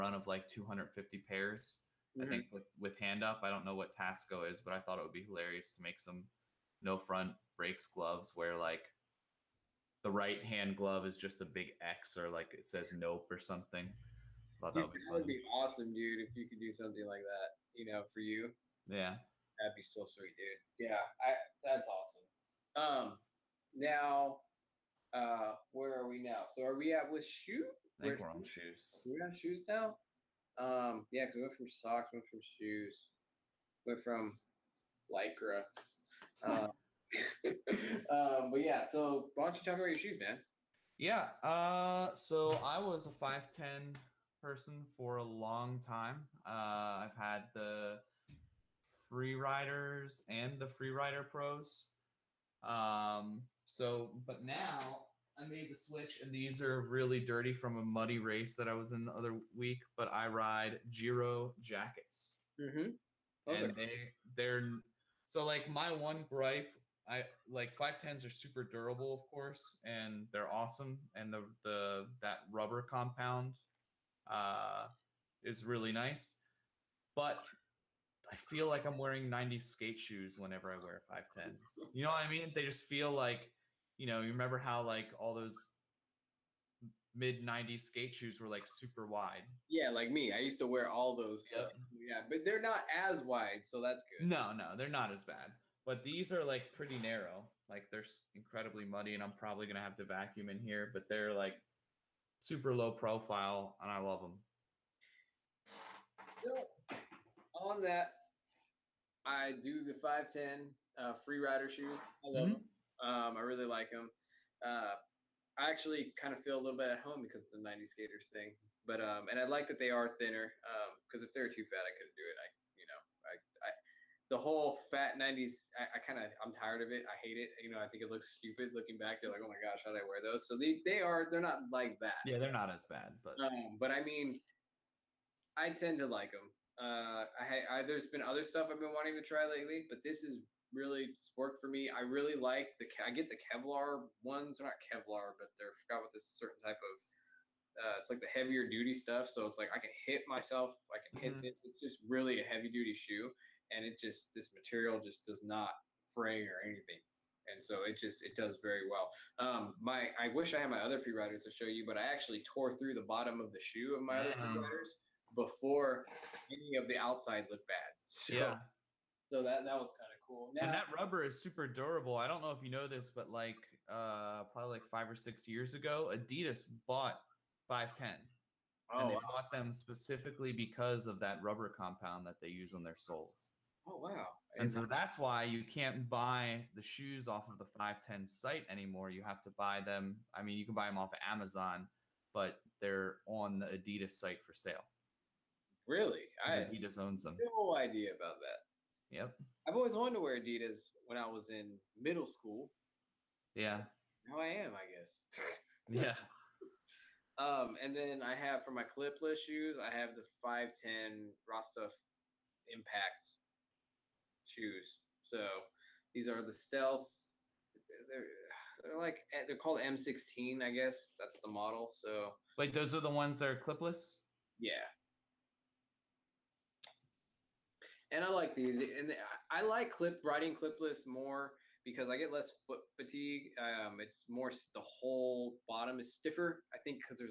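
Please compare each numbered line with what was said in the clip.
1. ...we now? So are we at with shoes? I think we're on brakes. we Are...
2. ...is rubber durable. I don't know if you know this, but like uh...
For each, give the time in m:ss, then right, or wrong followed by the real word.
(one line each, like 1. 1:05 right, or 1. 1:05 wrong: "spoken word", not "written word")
1. 0:26 wrong: "shoes", not "brakes"
2. 2:51 wrong: "super", not "rubber".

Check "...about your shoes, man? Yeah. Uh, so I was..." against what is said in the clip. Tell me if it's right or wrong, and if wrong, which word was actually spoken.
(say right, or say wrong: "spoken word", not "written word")
right.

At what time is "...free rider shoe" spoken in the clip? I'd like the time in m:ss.
1:51.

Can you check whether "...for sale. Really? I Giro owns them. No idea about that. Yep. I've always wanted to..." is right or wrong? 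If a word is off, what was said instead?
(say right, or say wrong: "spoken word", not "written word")
wrong: "Adidas", not "Giro".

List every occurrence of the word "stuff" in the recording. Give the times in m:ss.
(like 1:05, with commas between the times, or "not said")
2:18, 2:28.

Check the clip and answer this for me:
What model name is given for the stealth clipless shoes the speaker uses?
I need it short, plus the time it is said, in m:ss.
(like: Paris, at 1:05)
M16, at 3:39.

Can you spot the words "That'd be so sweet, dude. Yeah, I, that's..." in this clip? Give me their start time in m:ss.
0:19.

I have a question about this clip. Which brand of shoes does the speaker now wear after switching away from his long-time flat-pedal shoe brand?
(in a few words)
Giro.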